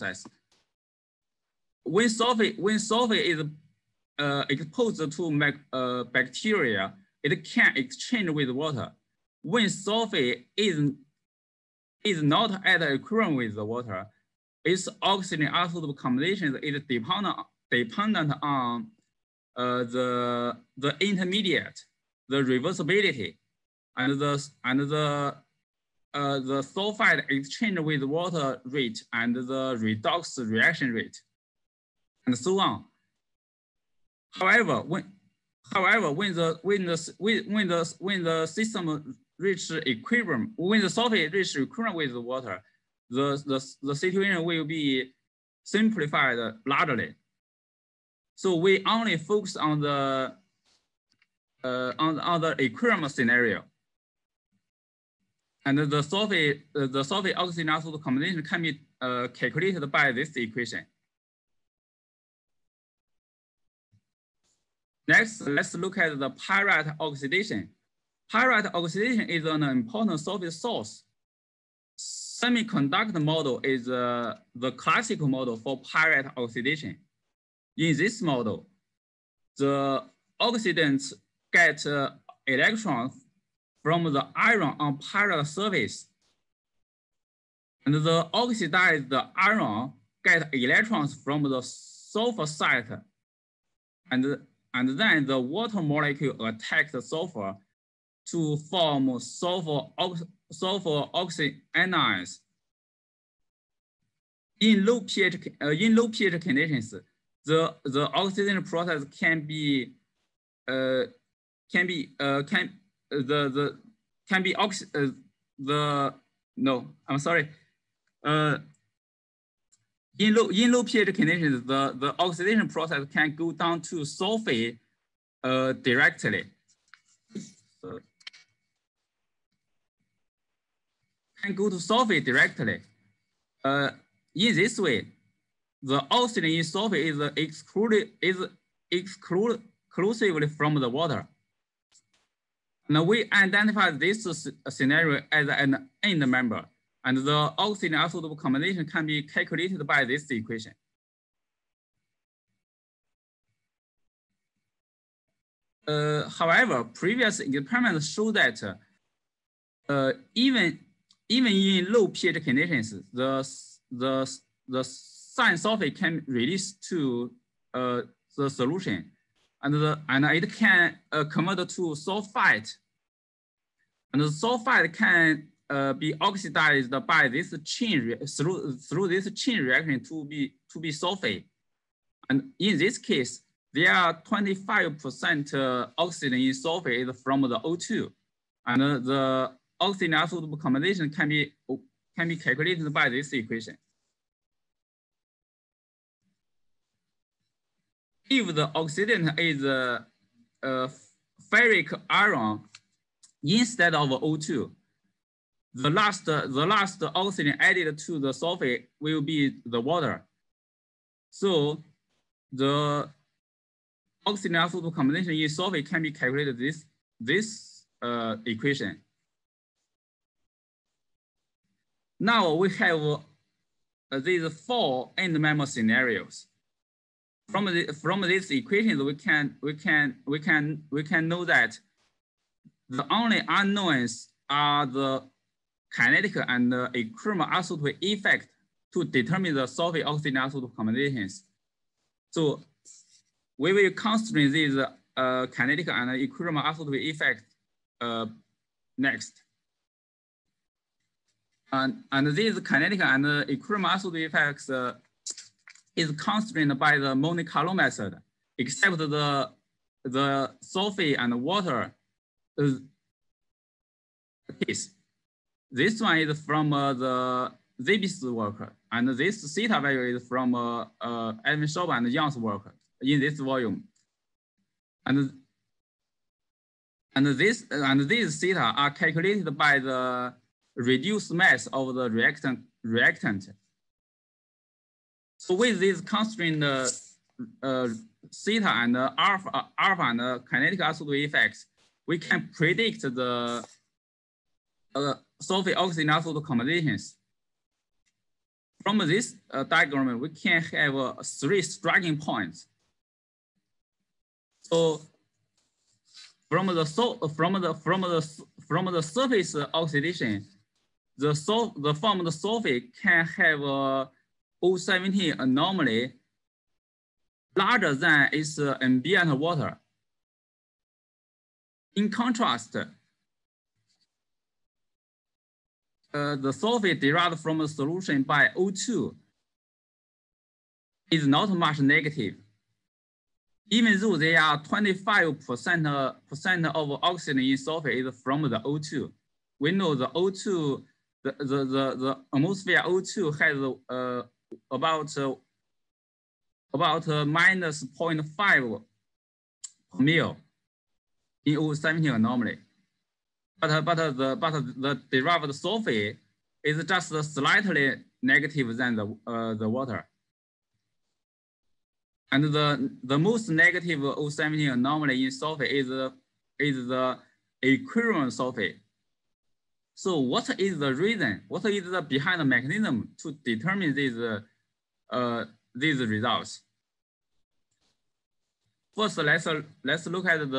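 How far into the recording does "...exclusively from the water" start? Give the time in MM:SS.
02:19.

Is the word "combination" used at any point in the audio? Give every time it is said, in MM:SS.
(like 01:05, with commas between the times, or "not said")
00:15, 00:58, 02:28, 03:10, 03:34, 04:00, 04:56.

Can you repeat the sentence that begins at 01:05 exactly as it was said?
Next, let's look at the pyrite oxidation.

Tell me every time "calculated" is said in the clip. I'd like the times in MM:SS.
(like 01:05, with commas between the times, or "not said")
00:59, 02:29, 03:12, 03:36, 04:38.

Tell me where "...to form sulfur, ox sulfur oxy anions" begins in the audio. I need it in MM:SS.
01:38.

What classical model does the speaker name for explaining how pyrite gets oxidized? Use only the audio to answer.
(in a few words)
Semiconductor model.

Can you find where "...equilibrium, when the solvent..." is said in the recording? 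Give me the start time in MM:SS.
00:39.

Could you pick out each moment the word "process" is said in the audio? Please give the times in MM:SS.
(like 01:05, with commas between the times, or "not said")
01:48, 02:02.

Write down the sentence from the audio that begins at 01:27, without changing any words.
And the oxidized iron get electrons from the sulfur site.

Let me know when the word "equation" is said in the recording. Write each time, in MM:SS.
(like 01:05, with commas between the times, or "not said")
01:00, 02:30, 03:13, 03:38, 03:48.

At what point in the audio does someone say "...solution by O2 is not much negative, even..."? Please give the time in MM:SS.
05:27.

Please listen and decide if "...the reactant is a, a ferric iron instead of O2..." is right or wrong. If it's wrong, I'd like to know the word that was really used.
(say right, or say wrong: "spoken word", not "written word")
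wrong: "oxidant", not "reactant".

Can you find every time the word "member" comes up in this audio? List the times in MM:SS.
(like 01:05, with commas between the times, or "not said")
02:26, 03:45.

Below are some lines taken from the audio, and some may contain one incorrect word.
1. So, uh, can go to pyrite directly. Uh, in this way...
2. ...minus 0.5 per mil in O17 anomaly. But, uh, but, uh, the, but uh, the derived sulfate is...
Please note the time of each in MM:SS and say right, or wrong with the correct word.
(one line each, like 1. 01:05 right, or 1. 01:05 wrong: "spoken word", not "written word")
1. 02:07 wrong: "sulfate", not "pyrite"
2. 05:47 right.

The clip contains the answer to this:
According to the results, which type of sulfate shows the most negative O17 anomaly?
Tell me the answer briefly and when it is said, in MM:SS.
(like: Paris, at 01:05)
Equilibrium sulfate, at 06:07.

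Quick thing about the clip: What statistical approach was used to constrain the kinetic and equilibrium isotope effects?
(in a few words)
Monte Carlo method.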